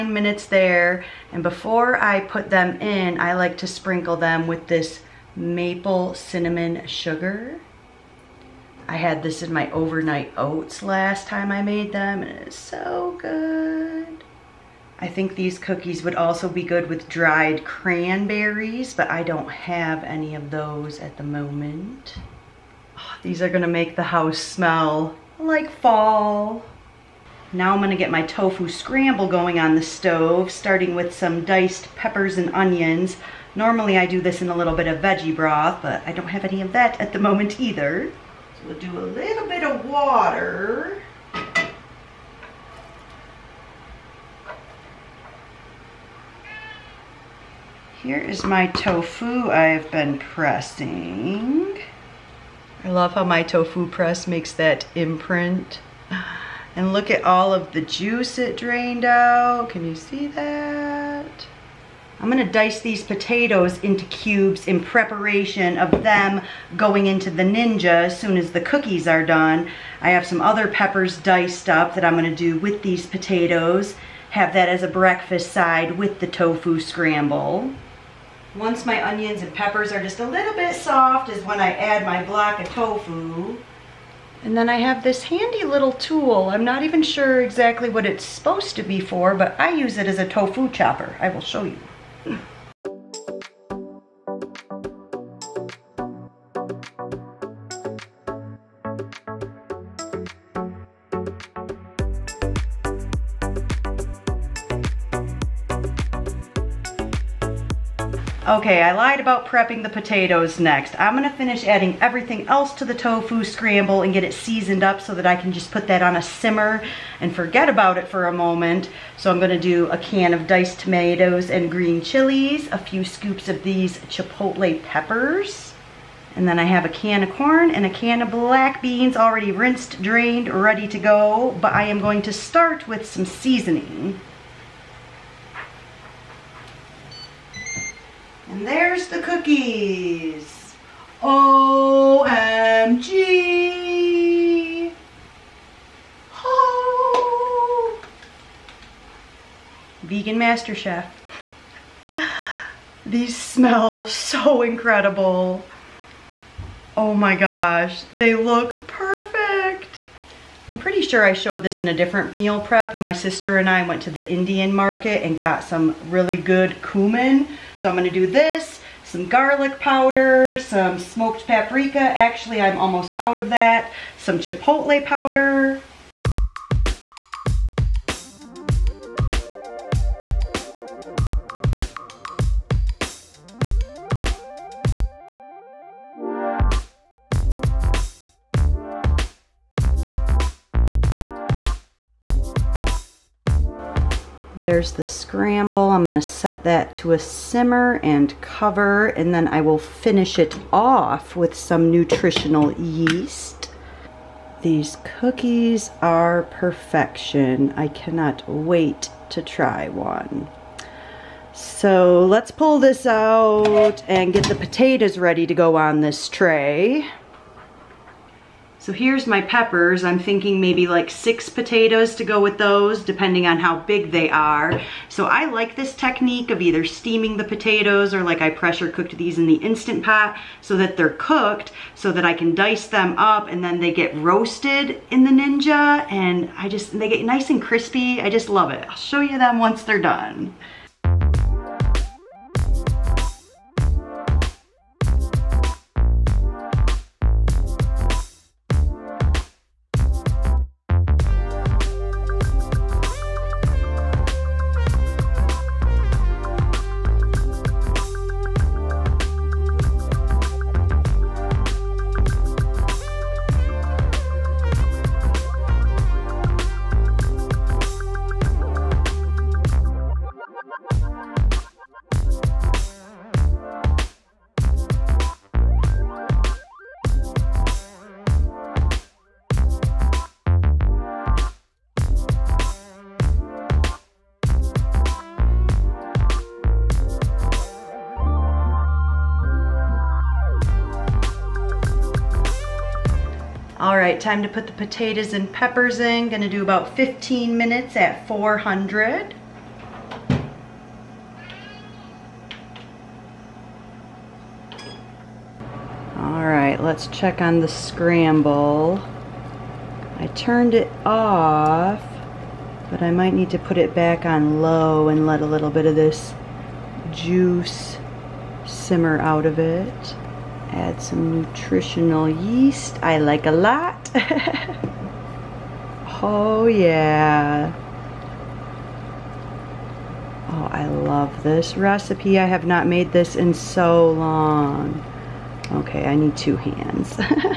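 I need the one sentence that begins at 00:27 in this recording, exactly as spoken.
Now I'm gonna get my tofu scramble going on the stove, starting with some diced peppers and onions.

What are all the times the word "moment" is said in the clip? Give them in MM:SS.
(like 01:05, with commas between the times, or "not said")
00:21, 00:37, 01:58.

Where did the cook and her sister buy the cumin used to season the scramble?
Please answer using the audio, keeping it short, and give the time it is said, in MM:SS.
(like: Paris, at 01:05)
the Indian market, at 02:44.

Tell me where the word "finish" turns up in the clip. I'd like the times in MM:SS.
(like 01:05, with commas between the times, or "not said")
01:51, 03:19.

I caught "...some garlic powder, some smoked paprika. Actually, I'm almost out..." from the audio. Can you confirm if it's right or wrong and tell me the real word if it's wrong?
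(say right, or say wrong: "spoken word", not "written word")
right.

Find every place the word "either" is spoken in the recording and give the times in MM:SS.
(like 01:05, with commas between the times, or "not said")
00:37, 03:46.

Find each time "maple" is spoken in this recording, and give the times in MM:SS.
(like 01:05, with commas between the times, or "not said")
00:05.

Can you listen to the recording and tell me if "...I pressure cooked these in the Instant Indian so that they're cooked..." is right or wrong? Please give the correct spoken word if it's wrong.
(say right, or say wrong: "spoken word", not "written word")
wrong: "Pot", not "Indian".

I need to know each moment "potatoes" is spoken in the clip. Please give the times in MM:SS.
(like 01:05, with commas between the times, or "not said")
01:03, 01:13, 01:49, 03:34, 03:41, 03:47, 04:54.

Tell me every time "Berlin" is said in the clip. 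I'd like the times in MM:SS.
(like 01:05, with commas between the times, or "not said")
not said.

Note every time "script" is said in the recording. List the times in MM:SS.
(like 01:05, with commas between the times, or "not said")
not said.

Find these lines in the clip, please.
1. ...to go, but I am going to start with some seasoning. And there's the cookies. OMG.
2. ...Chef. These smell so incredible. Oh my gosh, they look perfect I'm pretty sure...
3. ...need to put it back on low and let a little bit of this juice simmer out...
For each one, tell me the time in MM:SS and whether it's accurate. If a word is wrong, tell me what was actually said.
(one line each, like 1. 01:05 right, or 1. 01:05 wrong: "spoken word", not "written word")
1. 02:10 right
2. 02:30 right
3. 05:13 right.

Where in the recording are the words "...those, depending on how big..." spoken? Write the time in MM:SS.
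03:42.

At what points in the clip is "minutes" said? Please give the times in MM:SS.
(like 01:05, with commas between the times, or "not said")
00:00, 04:57.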